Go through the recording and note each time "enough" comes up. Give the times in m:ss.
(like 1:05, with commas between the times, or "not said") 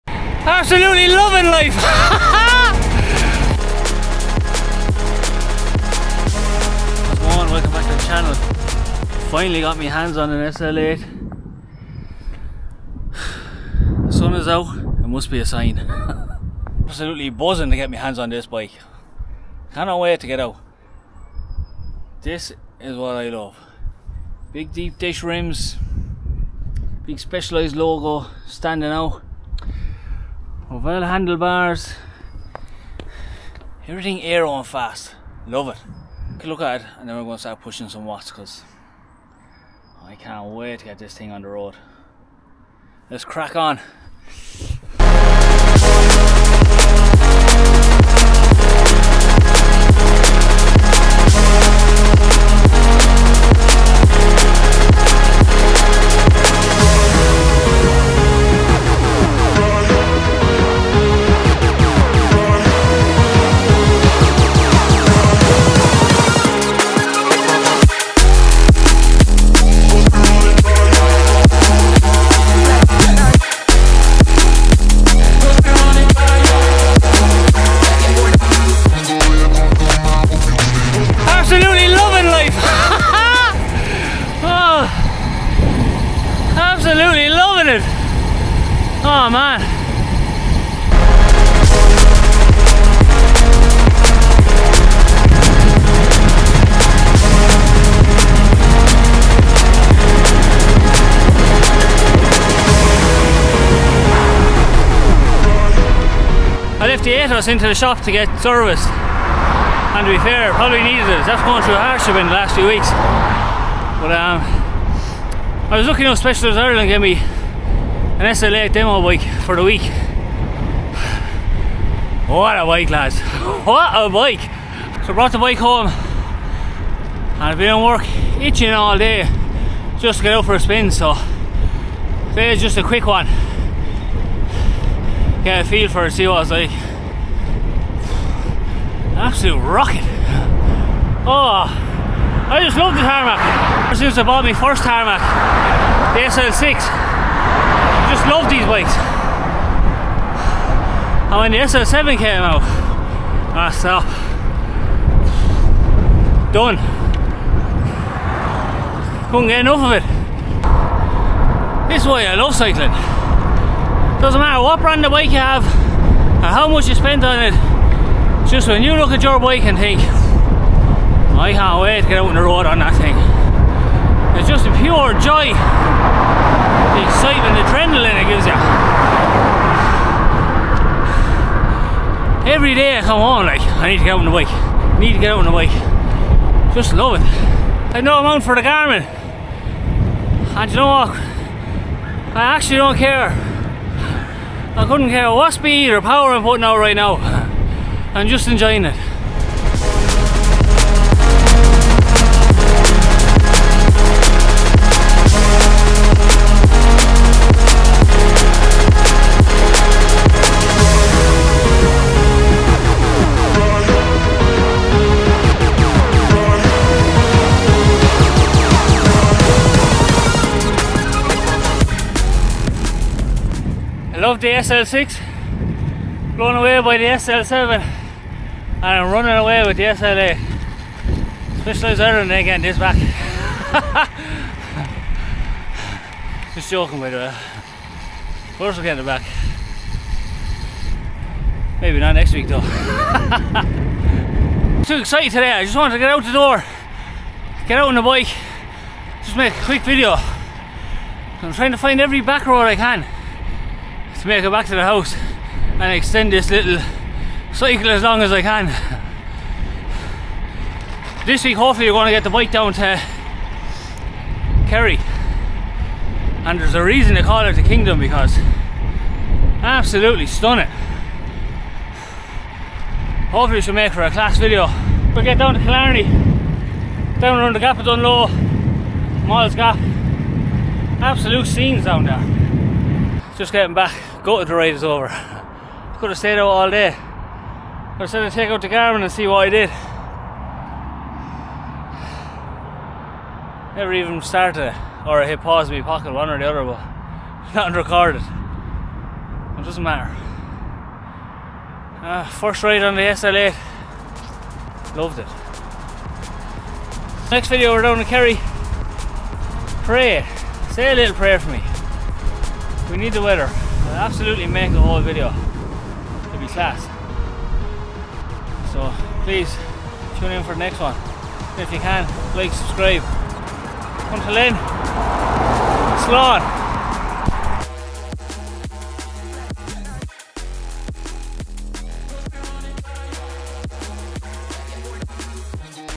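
1:56, 2:39.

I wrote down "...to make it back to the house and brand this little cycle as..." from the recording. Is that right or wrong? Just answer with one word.
wrong.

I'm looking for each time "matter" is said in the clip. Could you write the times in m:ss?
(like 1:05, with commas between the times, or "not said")
2:44, 4:59.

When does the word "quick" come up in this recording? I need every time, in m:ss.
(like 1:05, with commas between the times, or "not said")
2:12, 4:09.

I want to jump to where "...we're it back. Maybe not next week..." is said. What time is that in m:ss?
3:58.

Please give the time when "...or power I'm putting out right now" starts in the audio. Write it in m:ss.
3:15.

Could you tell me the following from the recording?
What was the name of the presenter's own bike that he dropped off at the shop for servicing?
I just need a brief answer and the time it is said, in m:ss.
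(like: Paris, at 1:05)
Ethos, at 1:47.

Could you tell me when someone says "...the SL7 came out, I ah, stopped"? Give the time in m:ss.
2:31.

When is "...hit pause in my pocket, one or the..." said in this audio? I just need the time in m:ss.
4:55.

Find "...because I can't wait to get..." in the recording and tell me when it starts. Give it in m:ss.
0:38.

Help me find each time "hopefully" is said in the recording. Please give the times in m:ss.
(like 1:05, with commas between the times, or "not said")
4:21, 4:33.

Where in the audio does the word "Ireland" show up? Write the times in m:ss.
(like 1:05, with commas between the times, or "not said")
1:56, 3:51.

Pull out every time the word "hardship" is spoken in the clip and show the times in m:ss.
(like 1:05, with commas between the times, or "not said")
1:51.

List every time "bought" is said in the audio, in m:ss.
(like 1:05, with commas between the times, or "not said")
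2:24.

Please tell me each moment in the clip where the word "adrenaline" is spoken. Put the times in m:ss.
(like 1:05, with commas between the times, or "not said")
2:57.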